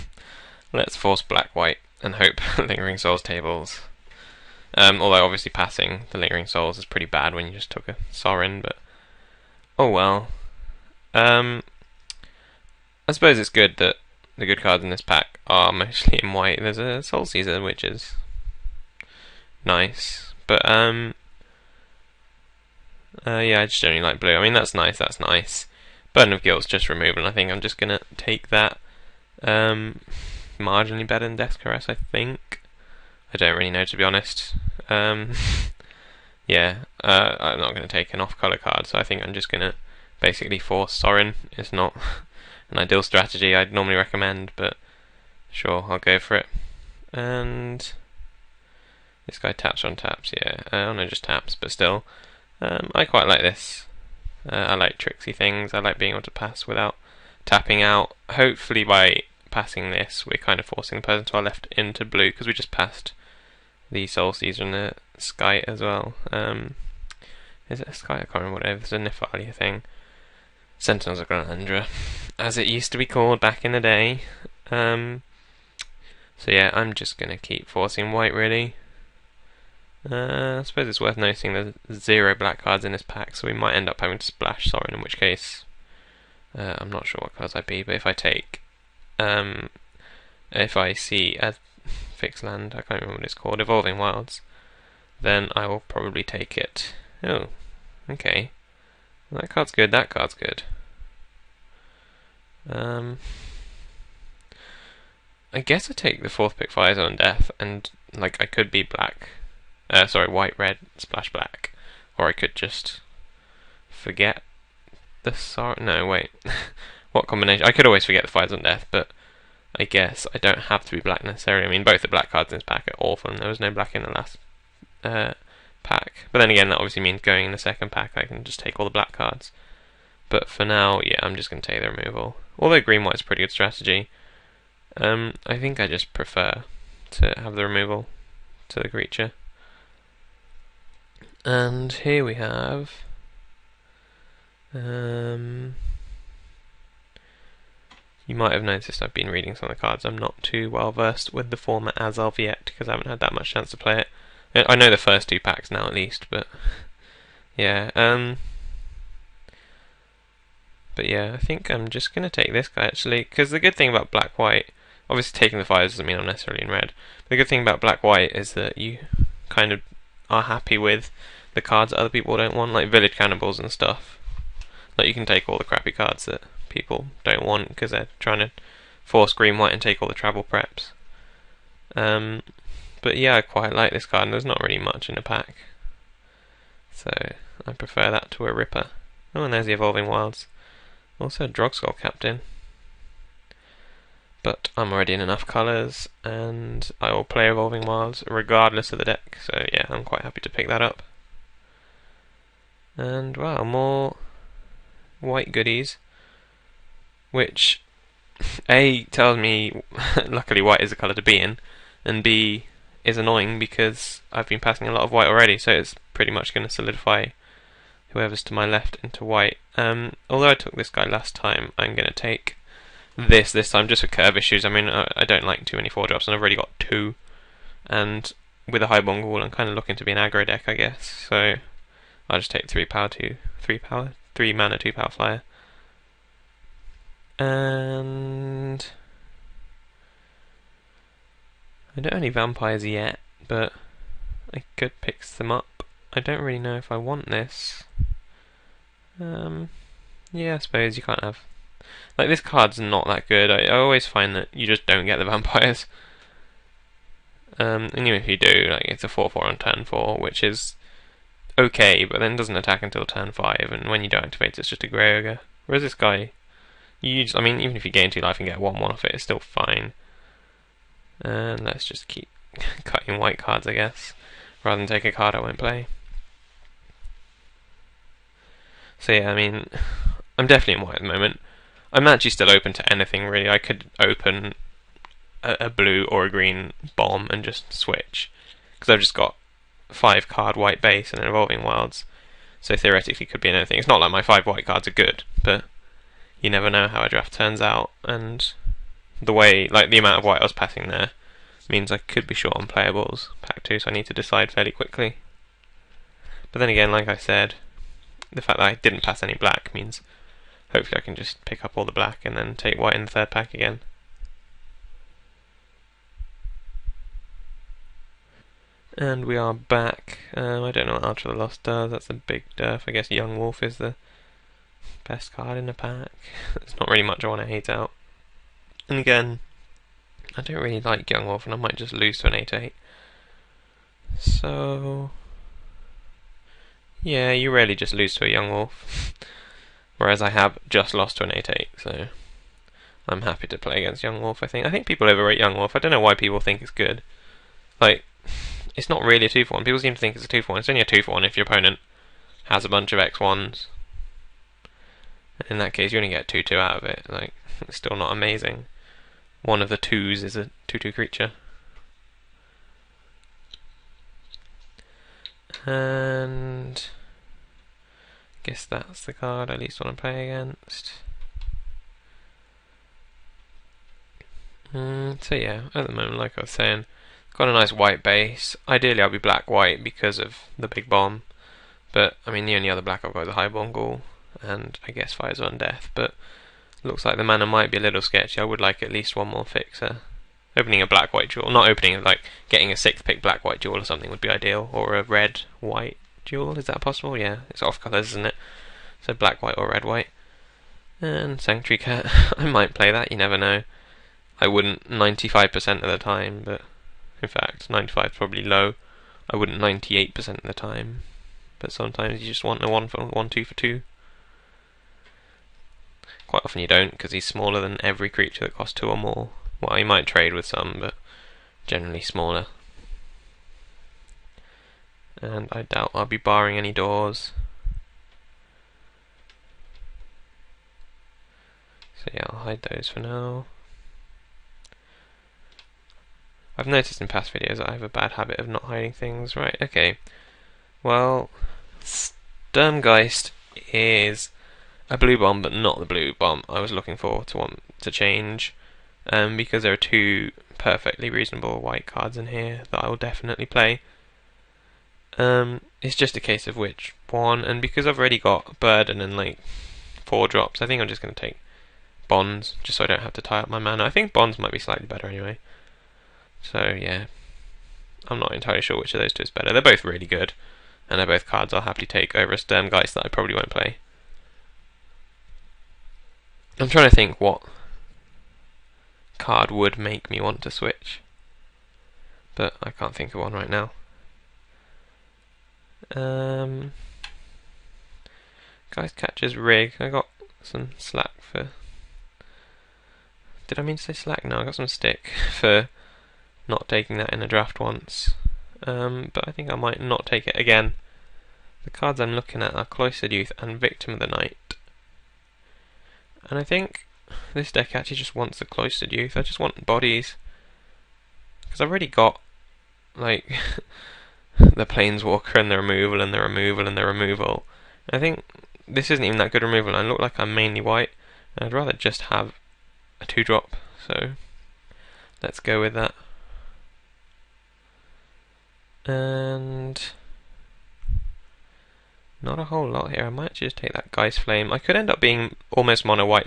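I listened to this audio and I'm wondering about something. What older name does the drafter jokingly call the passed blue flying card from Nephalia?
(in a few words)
Sentinels of Glen Elendra.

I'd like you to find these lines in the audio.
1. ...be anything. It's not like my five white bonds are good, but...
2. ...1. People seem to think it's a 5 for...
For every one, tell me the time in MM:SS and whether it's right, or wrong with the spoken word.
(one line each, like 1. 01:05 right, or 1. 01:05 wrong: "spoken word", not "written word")
1. 04:53 wrong: "cards", not "bonds"
2. 05:49 wrong: "2", not "5".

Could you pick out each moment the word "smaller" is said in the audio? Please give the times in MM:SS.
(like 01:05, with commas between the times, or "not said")
06:57, 07:02.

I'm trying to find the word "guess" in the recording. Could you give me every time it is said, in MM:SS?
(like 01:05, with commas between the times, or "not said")
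01:45, 01:59, 03:50, 04:33, 05:22, 06:08, 06:24.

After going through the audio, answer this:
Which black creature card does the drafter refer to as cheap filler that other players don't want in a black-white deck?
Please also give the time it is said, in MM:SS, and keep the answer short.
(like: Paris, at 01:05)
village cannibals, at 02:52.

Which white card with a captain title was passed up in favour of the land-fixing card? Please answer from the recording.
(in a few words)
Drogskol Captain.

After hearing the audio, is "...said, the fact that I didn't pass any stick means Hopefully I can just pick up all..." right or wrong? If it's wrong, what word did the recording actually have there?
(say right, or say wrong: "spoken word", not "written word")
wrong: "black", not "stick".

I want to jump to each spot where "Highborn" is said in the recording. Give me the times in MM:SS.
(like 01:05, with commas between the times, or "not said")
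03:48, 06:23.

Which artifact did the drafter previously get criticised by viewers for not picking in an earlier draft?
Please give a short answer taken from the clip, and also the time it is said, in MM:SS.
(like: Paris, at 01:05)
Geistcatcher's Rig, at 08:08.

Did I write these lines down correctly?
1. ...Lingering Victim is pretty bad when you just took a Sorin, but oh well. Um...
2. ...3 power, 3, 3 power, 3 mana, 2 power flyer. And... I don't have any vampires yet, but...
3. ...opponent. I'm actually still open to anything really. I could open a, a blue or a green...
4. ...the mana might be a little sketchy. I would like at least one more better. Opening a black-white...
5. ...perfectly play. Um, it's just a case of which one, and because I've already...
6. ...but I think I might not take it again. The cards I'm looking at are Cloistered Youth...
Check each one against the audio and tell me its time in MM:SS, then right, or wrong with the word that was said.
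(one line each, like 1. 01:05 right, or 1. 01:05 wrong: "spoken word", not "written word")
1. 00:06 wrong: "Souls", not "Victim"
2. 03:52 wrong: "2", not "3"
3. 04:41 wrong: "moment", not "opponent"
4. 06:27 wrong: "fixer", not "better"
5. 07:32 wrong: "definitely", not "perfectly"
6. 08:19 right.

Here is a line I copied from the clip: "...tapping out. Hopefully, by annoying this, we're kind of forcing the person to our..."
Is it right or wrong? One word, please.
wrong.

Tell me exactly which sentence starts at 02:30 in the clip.
I'm not too well versed with the format as of yet because I haven't had that much chance to play it.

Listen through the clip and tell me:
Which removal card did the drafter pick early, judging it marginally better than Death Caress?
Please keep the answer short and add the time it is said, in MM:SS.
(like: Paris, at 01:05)
Burden of Guilt, at 00:26.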